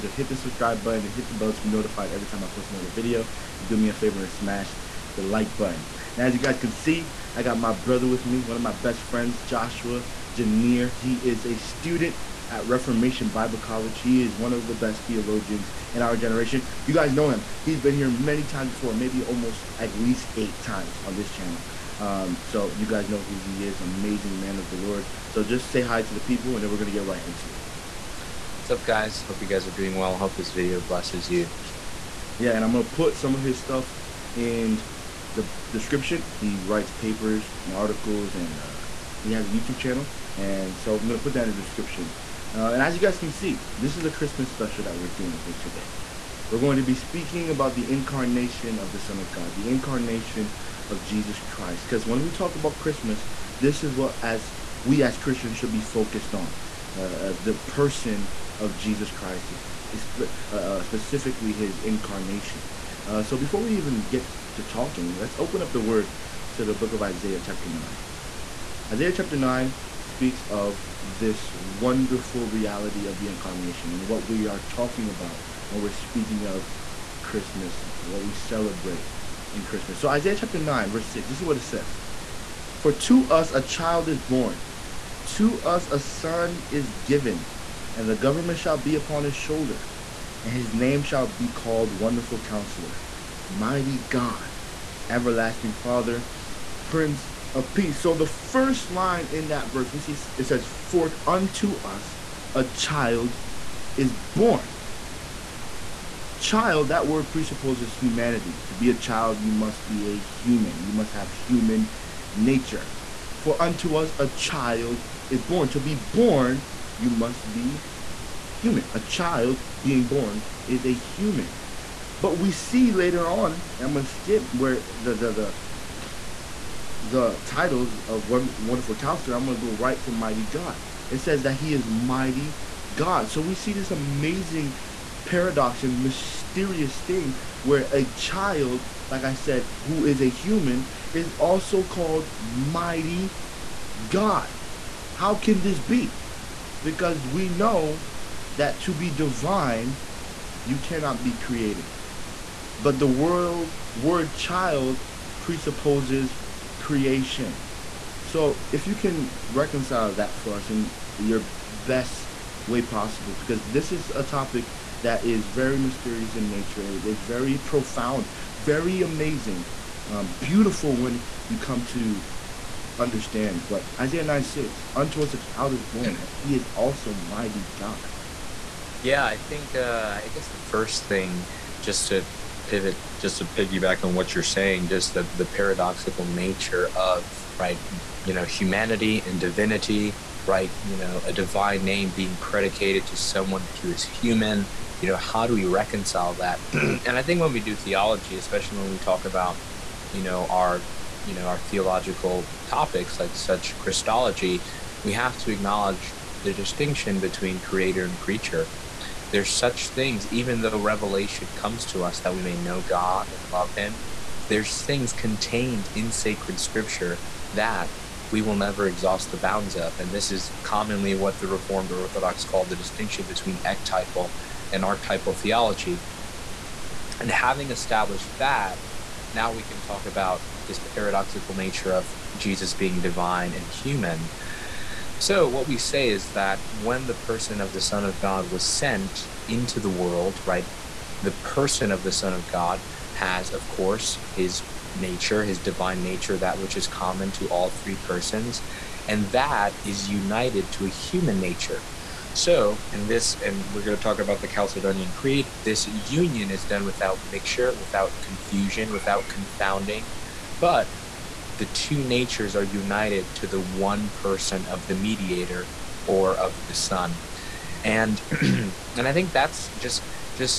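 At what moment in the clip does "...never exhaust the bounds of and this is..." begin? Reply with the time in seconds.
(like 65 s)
218 s.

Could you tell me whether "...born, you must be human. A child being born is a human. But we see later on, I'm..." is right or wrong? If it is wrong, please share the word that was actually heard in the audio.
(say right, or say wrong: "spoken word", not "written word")
right.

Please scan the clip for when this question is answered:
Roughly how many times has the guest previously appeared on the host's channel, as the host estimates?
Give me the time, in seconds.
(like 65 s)
20 s.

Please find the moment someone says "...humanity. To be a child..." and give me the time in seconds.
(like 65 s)
107 s.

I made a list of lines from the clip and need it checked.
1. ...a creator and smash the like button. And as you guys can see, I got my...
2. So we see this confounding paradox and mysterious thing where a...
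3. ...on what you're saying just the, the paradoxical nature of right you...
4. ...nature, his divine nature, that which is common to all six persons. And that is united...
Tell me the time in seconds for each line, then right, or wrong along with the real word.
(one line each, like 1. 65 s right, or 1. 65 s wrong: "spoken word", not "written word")
1. 3 s wrong: "favor", not "creator"
2. 133 s wrong: "amazing", not "confounding"
3. 184 s right
4. 244 s wrong: "three", not "six".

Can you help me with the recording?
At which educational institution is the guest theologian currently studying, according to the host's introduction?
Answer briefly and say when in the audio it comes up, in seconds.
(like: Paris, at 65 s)
Reformation Bible College, at 12 s.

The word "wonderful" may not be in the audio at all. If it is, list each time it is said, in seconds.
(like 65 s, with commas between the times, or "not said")
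71 s, 91 s, 128 s.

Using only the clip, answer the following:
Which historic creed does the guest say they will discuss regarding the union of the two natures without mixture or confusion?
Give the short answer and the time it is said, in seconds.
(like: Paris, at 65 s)
Chalcedonian Creed, at 254 s.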